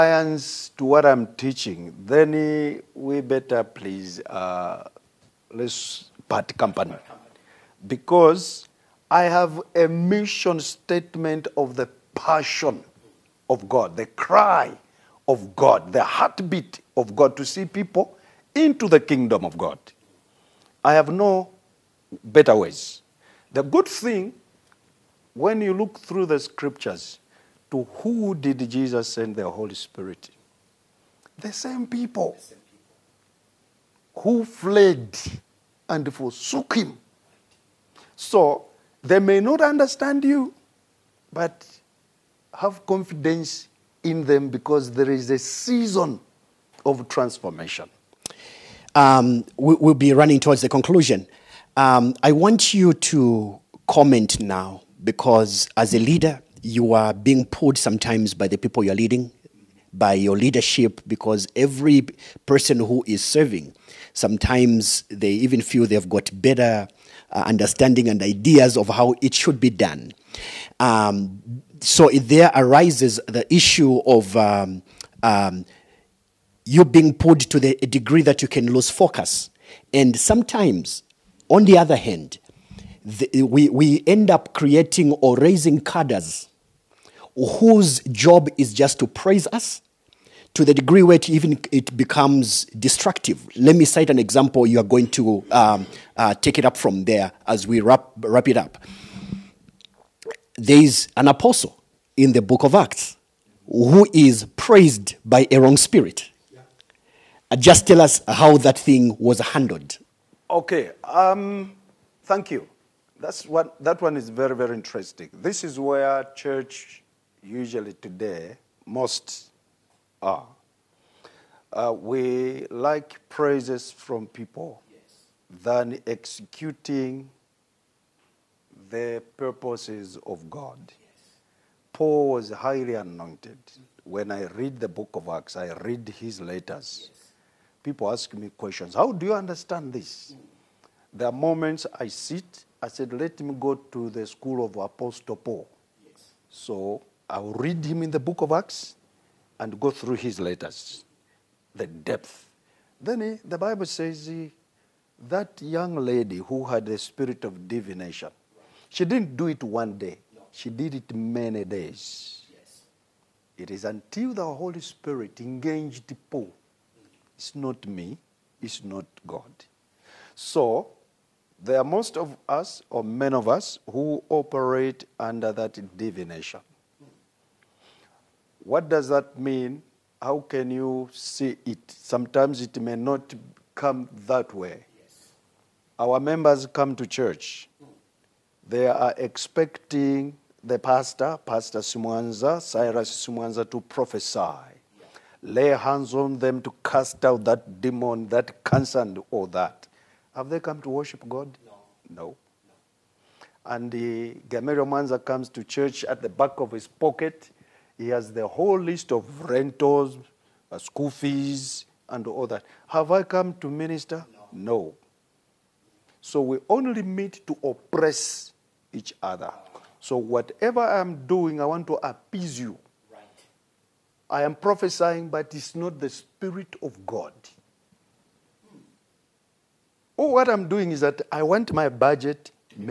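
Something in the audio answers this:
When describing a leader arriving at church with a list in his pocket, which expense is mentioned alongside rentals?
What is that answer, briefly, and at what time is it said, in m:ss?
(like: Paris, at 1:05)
School fees, at 3:30.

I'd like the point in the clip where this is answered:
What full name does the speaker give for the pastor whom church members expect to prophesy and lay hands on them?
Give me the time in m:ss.
3:12.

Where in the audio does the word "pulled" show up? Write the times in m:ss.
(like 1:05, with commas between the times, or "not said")
0:57, 1:17.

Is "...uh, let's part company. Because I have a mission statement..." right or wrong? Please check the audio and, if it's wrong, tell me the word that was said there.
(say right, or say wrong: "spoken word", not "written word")
right.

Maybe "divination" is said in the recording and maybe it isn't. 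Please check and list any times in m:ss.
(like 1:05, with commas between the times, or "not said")
2:37, 2:55.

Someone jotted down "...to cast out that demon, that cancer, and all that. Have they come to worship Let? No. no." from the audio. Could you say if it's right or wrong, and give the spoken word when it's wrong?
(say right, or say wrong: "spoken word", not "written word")
wrong: "God", not "Let".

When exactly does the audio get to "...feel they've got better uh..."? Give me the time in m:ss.
1:05.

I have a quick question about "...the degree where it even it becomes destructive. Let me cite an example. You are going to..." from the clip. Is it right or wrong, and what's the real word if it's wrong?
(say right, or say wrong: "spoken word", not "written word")
right.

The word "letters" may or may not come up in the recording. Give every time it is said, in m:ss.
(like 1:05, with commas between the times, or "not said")
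2:16, 2:30.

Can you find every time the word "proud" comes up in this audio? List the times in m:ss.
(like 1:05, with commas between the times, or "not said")
not said.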